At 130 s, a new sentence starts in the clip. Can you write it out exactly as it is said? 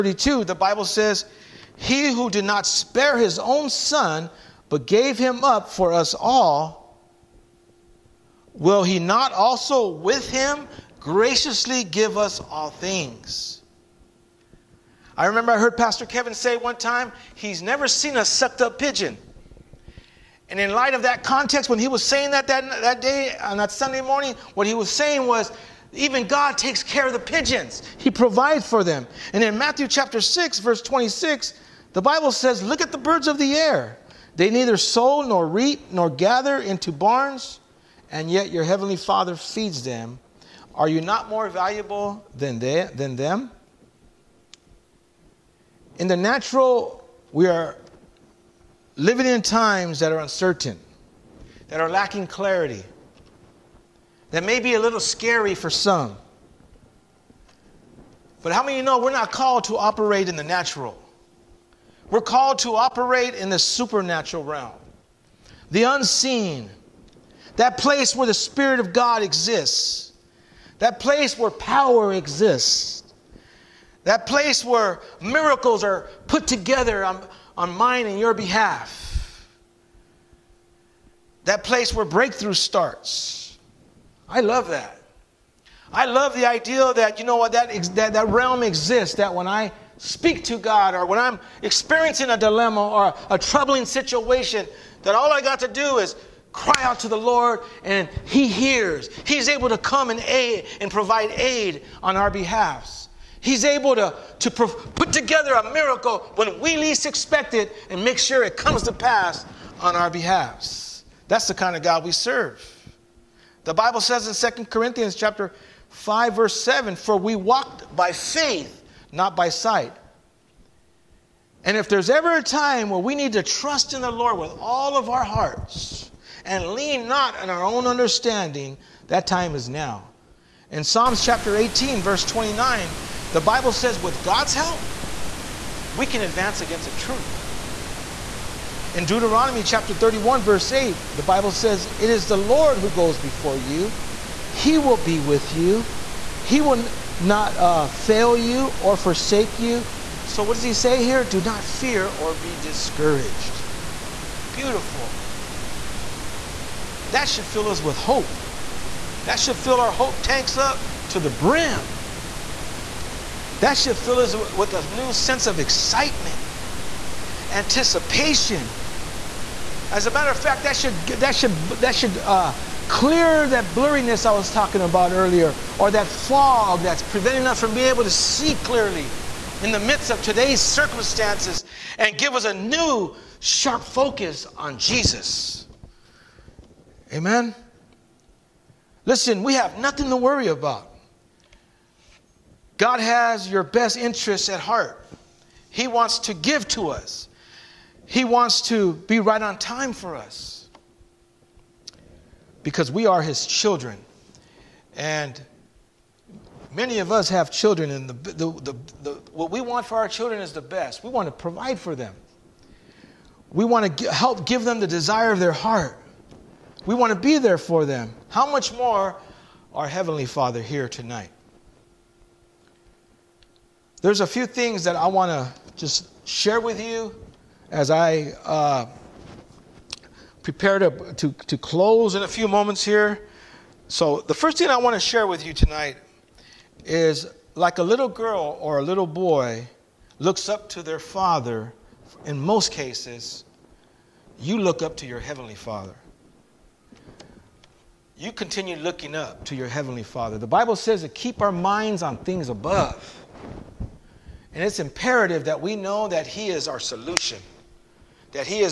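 In Psalms chapter 18, verse 29, the Bible says with God's help, we can advance against a troop.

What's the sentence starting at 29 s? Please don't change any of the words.
And in Matthew chapter 6, verse 26, the Bible says, Look at the birds of the air.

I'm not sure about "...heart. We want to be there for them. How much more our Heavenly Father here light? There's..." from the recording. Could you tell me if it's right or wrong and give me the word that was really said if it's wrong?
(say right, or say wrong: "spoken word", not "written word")
wrong: "tonight", not "light".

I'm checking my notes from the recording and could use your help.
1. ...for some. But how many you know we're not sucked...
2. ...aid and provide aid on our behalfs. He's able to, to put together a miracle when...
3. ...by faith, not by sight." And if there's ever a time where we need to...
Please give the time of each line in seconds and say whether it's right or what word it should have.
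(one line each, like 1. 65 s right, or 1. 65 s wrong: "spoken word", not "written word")
1. 55 s wrong: "called", not "sucked"
2. 100 s right
3. 117 s right.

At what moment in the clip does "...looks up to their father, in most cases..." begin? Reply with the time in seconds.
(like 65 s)
240 s.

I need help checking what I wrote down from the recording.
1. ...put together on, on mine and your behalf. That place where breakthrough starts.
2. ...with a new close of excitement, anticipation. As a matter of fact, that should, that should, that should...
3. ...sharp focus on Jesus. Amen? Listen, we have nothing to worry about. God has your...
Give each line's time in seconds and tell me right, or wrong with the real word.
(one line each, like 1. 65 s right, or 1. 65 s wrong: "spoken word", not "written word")
1. 76 s right
2. 164 s wrong: "sense", not "close"
3. 183 s right.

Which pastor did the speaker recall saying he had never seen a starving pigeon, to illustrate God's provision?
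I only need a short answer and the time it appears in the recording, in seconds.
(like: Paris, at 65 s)
Pastor Kevin, at 15 s.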